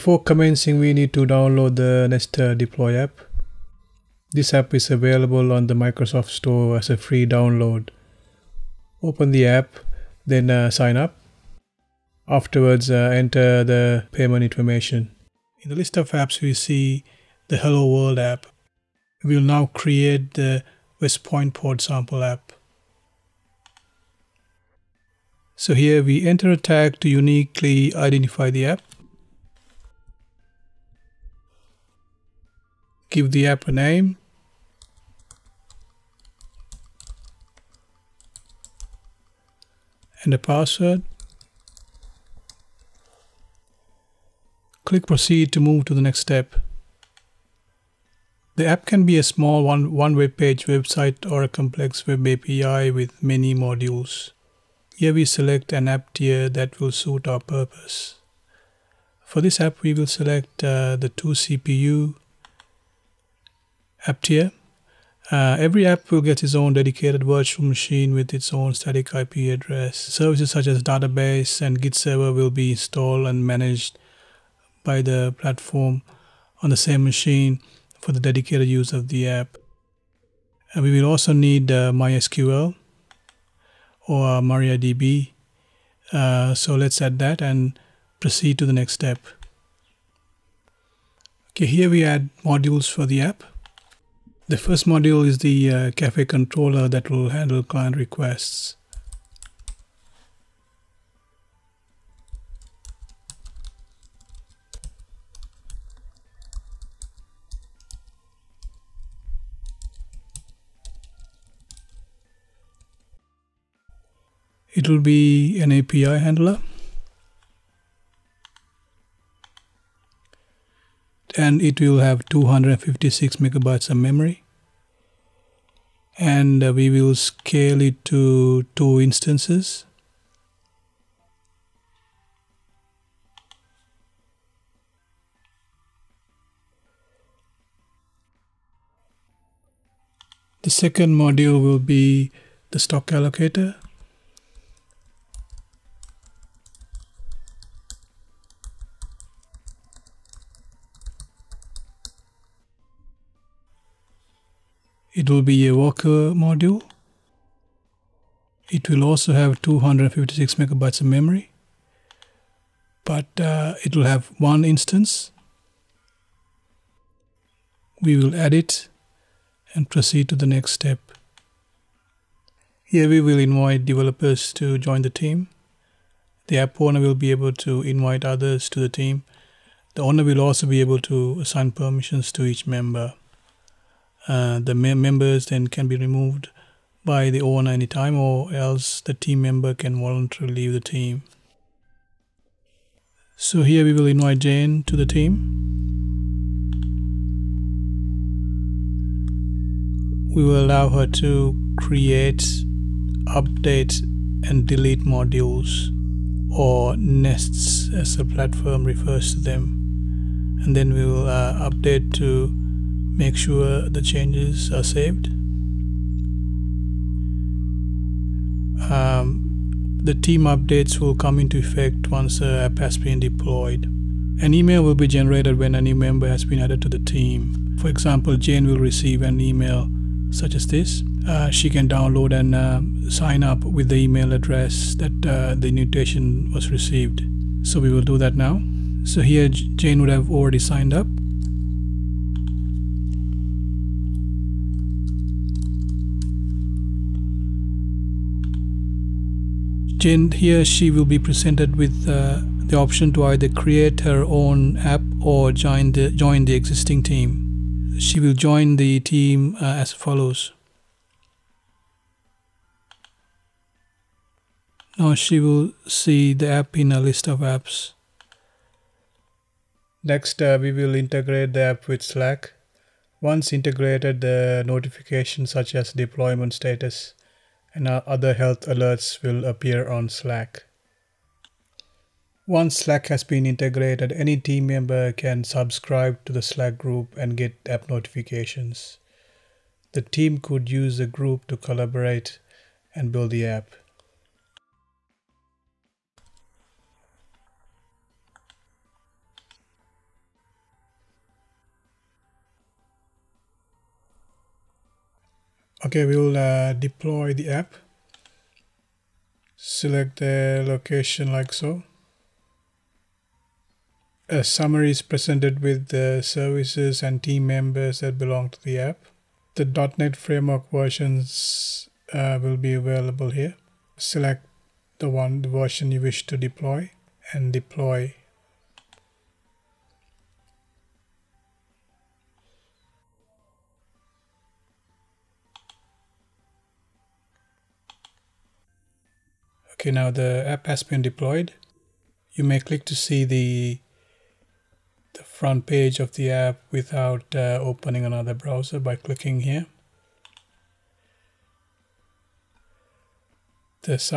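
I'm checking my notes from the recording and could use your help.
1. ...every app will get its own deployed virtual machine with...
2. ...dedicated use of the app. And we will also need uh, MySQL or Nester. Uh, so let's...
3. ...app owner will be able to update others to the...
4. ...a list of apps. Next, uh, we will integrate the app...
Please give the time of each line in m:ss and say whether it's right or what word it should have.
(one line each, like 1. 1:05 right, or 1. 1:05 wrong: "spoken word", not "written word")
1. 1:05 wrong: "dedicated", not "deployed"
2. 1:18 wrong: "MariaDB", not "Nester"
3. 2:56 wrong: "invite", not "update"
4. 4:26 right.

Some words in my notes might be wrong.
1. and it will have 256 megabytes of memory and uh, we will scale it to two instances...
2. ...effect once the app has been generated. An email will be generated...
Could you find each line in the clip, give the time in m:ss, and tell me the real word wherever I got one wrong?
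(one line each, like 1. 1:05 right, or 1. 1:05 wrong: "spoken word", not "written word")
1. 2:01 right
2. 3:41 wrong: "deployed", not "generated".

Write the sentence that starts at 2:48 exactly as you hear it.
We will add it and proceed to the next step.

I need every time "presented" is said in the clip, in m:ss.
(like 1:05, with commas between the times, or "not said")
4:11, 5:15.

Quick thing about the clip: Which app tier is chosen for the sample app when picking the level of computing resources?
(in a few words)
2CPU.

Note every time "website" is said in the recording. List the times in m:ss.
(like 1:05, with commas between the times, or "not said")
0:50.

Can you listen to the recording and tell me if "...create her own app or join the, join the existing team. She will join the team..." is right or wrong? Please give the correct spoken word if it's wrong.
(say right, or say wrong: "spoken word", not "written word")
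right.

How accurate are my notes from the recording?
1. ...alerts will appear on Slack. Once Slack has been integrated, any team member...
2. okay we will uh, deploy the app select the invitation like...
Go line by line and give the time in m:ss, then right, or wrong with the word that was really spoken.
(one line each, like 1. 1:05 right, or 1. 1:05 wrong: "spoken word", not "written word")
1. 4:38 right
2. 5:05 wrong: "location", not "invitation".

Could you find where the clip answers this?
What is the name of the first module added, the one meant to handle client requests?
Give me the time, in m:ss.
1:35.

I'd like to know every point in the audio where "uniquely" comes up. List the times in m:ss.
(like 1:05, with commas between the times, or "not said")
0:27.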